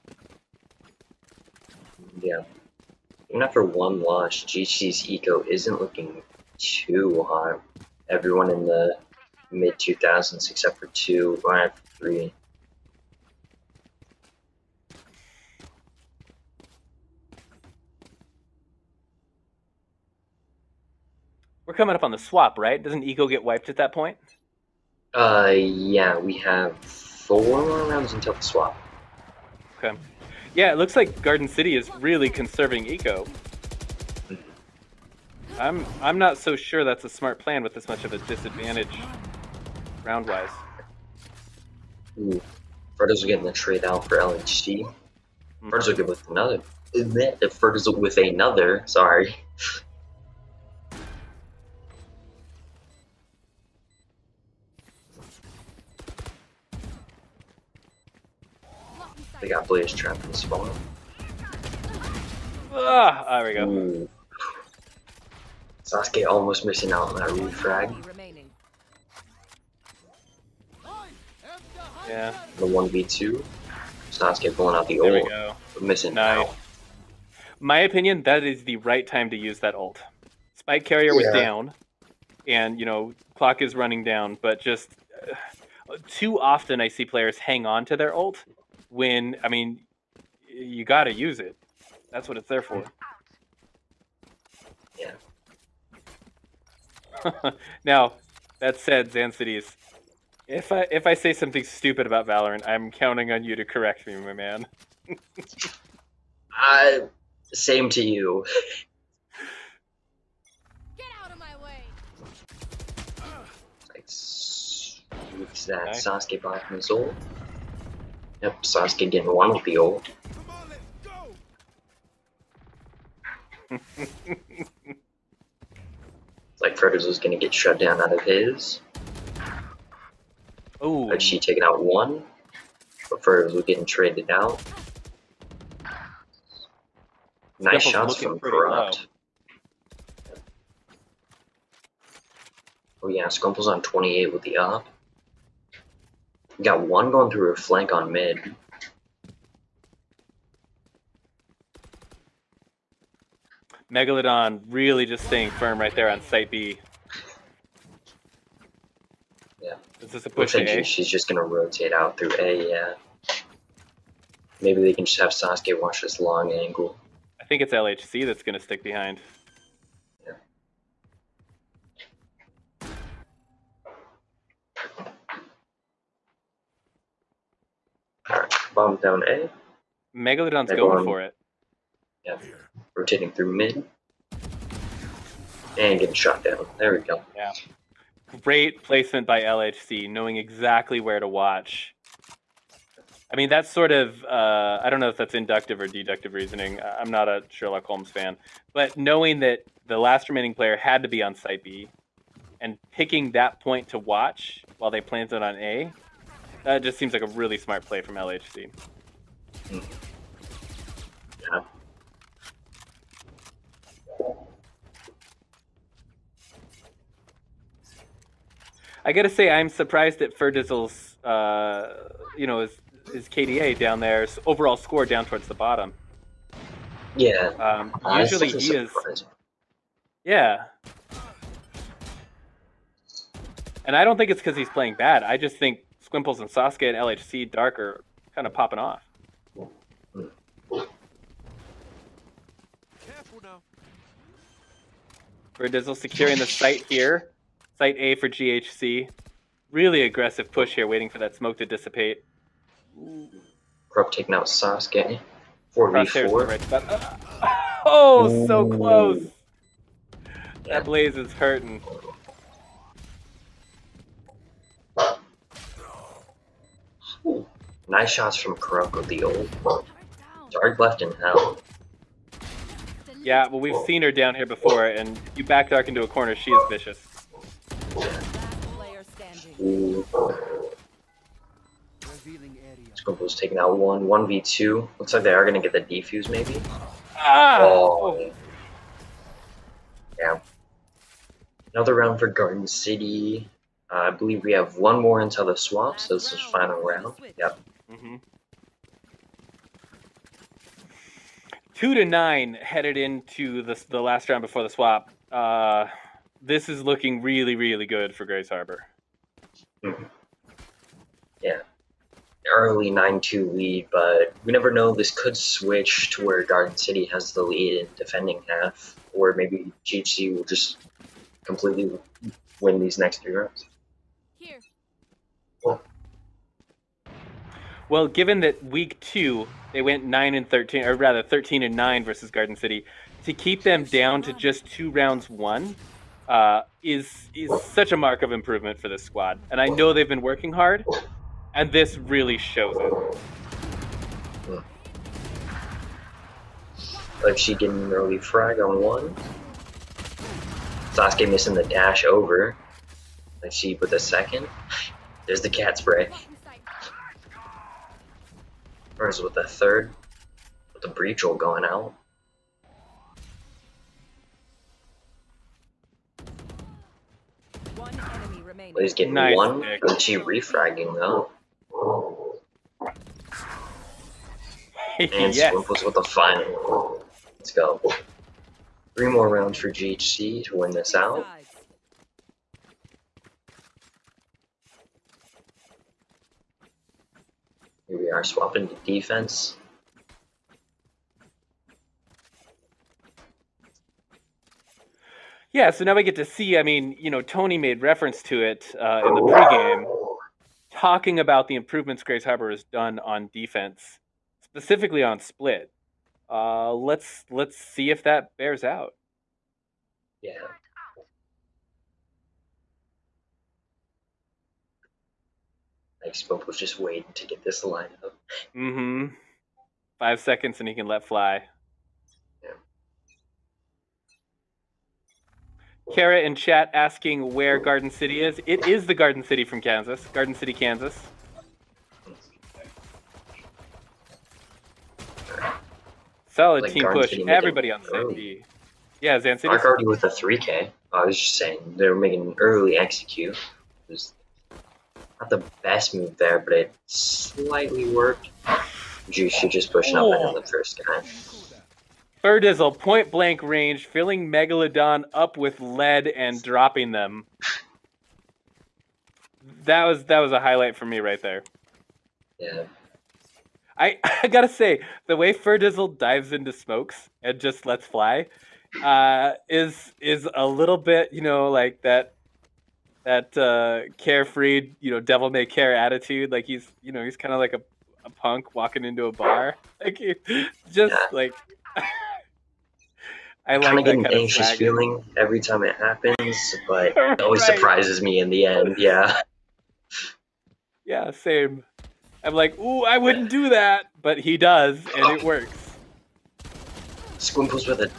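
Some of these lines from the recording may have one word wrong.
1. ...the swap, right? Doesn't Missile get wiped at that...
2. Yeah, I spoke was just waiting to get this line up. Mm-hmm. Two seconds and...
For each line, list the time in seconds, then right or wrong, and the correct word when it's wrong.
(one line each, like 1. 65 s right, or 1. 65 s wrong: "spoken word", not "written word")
1. 22 s wrong: "Eco", not "Missile"
2. 410 s wrong: "Five", not "Two".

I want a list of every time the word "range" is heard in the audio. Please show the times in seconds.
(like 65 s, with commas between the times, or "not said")
453 s.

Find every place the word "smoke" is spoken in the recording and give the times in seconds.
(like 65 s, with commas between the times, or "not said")
251 s, 466 s.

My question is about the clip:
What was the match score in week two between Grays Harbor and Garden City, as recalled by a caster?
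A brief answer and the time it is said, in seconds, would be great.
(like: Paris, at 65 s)
13-9, at 331 s.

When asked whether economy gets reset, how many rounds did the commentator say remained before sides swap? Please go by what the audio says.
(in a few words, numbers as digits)
4.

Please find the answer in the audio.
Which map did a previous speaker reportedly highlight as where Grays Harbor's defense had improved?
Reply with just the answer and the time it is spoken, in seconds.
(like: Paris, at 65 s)
Split, at 405 s.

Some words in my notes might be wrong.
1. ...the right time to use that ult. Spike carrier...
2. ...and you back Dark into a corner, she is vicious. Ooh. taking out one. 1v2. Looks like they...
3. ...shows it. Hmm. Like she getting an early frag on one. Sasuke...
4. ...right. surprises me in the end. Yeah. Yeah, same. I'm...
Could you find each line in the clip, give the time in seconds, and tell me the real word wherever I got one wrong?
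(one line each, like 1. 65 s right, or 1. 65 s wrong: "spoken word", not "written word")
1. 78 s right
2. 274 s right
3. 342 s right
4. 487 s right.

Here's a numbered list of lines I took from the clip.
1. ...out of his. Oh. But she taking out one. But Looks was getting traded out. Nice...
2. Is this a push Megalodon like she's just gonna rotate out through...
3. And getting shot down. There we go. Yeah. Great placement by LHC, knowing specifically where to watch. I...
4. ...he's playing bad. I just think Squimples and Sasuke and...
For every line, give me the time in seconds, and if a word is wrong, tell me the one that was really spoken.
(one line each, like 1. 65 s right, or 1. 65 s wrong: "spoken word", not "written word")
1. 128 s wrong: "Fritters", not "Looks"
2. 160 s wrong: "Looks", not "Megalodon"
3. 185 s wrong: "exactly", not "specifically"
4. 234 s right.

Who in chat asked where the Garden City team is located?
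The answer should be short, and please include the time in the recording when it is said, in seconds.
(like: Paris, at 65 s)
Kara, at 425 s.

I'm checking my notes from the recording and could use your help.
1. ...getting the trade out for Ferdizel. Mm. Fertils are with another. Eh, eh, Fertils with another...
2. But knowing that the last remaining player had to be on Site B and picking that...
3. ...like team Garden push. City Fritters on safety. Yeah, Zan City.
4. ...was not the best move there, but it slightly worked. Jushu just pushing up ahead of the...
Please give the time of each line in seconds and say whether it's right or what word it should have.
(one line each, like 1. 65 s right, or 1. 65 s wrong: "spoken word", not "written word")
1. 43 s wrong: "LHD", not "Ferdizel"
2. 198 s right
3. 436 s wrong: "Everybody", not "Fritters"
4. 443 s right.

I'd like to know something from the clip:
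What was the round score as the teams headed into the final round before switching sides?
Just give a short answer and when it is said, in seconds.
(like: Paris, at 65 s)
2 to 9, at 301 s.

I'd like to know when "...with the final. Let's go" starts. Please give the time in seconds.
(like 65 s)
375 s.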